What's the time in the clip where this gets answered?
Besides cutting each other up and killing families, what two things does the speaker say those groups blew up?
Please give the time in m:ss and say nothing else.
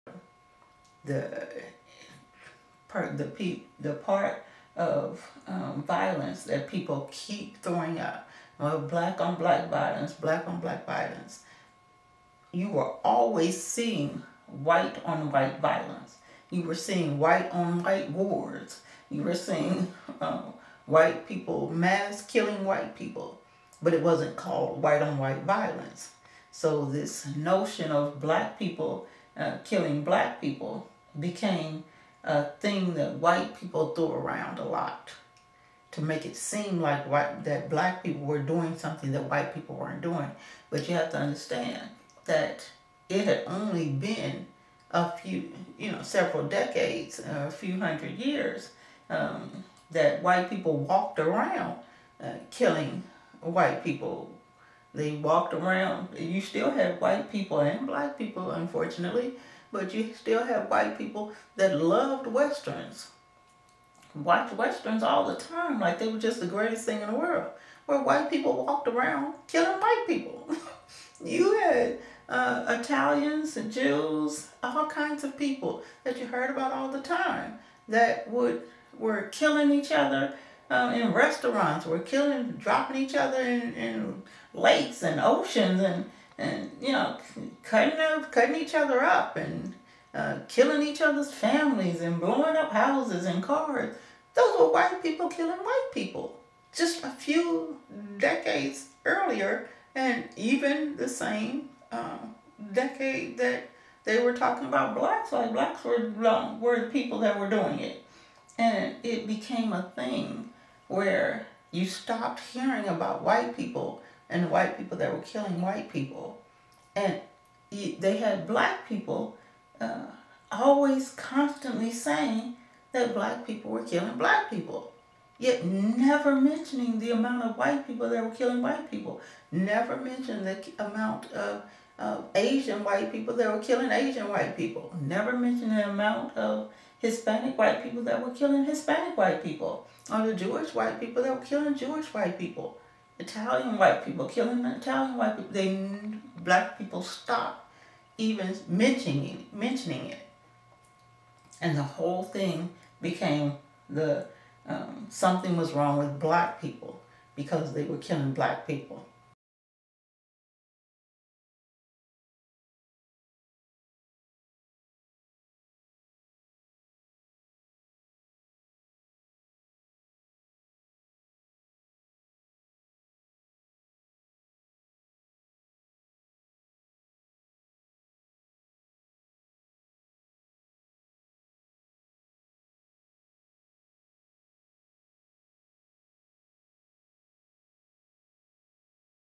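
1:32.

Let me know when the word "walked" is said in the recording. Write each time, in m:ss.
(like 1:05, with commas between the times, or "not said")
0:50, 0:55, 1:08.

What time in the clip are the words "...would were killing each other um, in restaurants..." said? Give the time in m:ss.
1:18.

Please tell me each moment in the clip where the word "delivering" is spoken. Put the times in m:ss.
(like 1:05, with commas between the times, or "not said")
not said.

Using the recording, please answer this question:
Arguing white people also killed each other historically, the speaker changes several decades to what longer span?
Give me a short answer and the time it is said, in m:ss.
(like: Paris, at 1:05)
a few hundred years, at 0:47.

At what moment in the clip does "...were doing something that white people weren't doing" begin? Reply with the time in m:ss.
0:38.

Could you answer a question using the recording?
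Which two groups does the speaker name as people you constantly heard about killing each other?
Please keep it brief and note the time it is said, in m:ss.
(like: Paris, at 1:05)
Italians and Jews, at 1:12.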